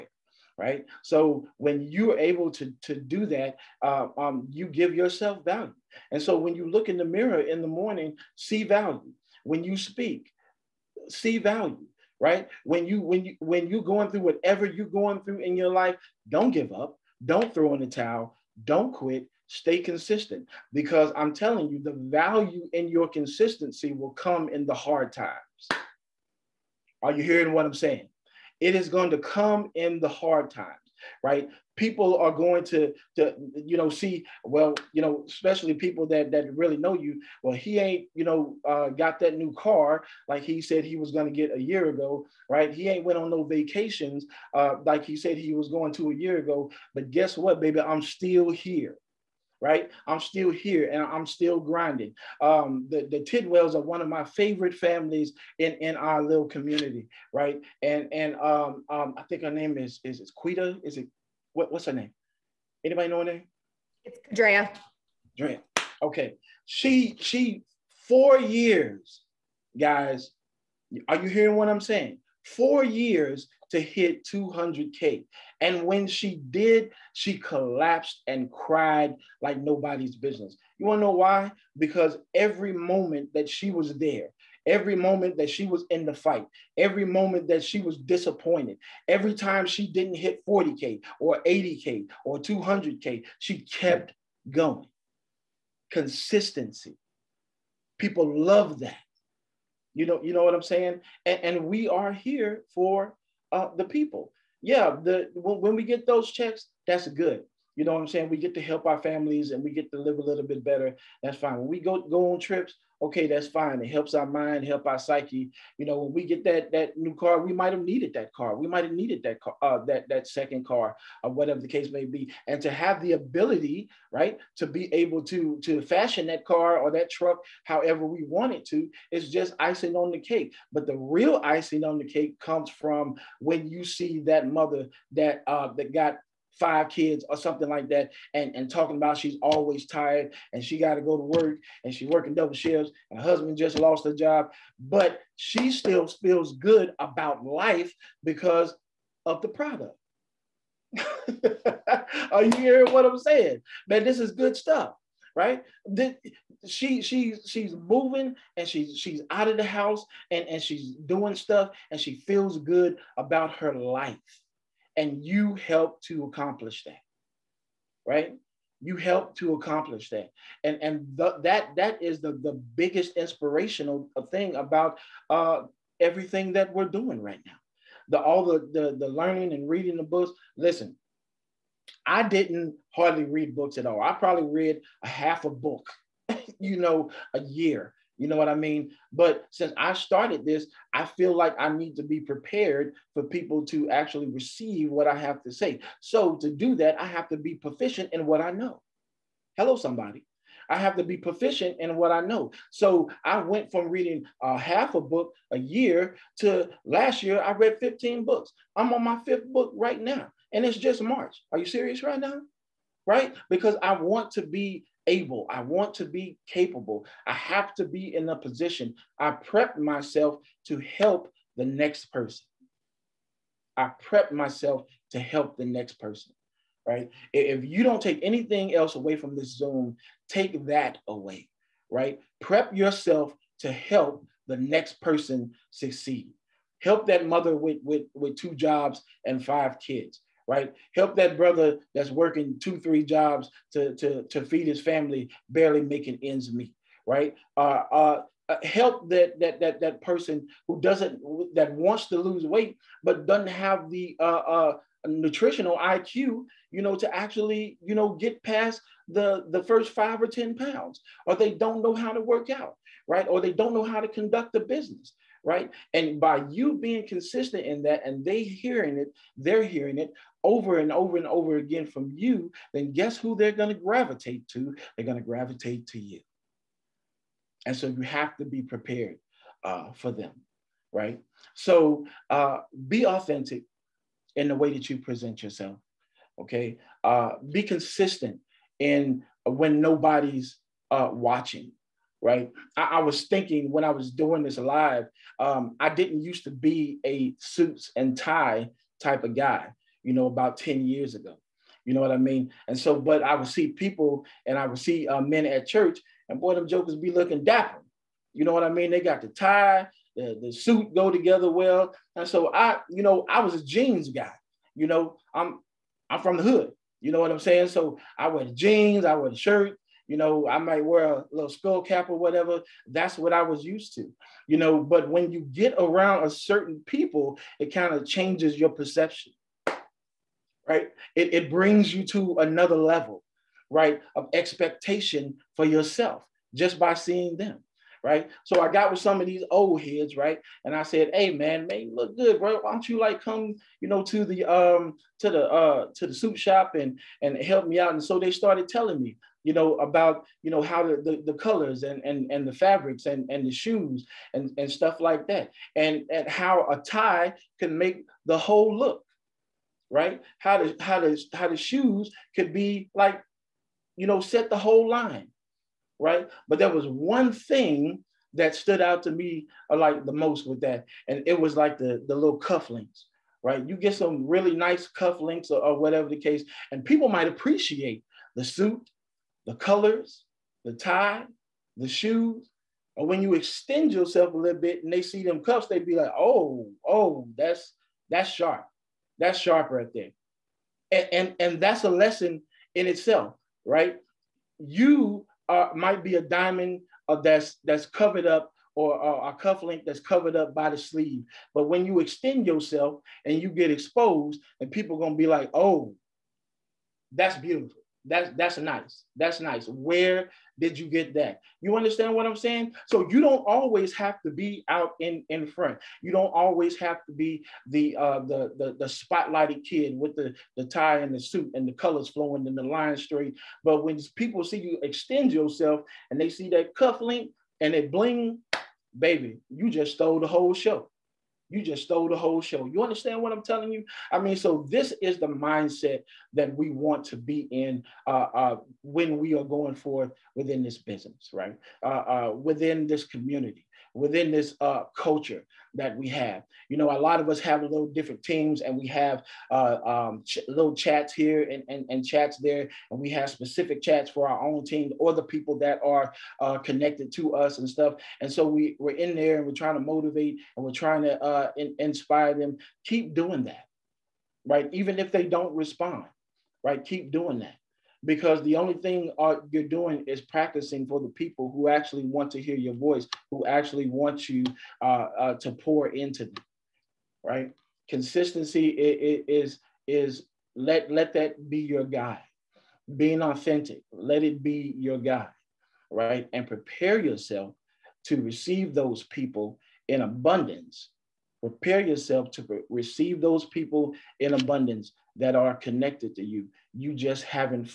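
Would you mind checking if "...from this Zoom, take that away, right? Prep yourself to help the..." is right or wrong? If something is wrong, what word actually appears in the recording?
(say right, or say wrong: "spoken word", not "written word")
right.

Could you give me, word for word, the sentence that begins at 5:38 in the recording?
So I got with some of these old heads, right?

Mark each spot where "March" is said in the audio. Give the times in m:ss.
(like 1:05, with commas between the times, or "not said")
3:31.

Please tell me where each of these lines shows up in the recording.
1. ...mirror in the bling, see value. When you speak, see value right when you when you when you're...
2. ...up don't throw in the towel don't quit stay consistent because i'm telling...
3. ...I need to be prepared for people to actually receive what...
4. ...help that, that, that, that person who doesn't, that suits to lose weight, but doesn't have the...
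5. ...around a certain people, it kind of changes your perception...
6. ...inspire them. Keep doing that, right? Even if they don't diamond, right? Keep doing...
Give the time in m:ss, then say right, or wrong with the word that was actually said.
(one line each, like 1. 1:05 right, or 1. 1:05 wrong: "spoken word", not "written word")
1. 0:07 wrong: "morning", not "bling"
2. 0:16 right
3. 3:11 right
4. 4:08 wrong: "wants", not "suits"
5. 5:25 right
6. 7:41 wrong: "respond", not "diamond".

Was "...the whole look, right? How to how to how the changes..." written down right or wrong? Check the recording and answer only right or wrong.
wrong.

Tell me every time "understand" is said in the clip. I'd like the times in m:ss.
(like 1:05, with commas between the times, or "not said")
6:51, 7:12.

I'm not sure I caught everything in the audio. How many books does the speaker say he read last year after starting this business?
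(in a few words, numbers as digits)
15.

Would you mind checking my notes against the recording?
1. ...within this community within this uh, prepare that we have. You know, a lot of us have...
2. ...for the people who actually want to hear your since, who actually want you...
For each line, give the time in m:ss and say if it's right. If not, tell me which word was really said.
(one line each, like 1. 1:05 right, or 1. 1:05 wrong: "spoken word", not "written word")
1. 7:22 wrong: "culture", not "prepare"
2. 7:50 wrong: "voice", not "since".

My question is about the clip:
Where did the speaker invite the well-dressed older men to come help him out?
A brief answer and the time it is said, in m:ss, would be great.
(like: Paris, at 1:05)
the soup shop, at 5:46.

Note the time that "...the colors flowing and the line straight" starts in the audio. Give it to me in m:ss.
7:01.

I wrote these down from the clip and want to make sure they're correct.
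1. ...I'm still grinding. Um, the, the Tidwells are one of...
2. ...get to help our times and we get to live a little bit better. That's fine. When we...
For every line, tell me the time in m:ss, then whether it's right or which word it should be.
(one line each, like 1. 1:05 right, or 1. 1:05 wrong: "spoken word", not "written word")
1. 0:51 right
2. 1:48 wrong: "families", not "times".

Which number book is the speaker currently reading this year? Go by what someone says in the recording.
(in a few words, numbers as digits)
fifth.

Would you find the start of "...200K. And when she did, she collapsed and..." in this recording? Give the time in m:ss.
1:14.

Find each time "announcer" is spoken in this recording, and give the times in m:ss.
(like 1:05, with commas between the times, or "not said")
not said.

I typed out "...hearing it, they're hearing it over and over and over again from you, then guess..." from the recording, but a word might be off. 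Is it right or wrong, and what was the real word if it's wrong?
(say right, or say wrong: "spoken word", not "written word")
right.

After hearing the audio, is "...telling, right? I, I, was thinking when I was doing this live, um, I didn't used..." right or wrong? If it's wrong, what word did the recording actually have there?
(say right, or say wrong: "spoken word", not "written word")
wrong: "watching", not "telling".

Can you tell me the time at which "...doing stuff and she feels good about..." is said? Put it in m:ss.
2:40.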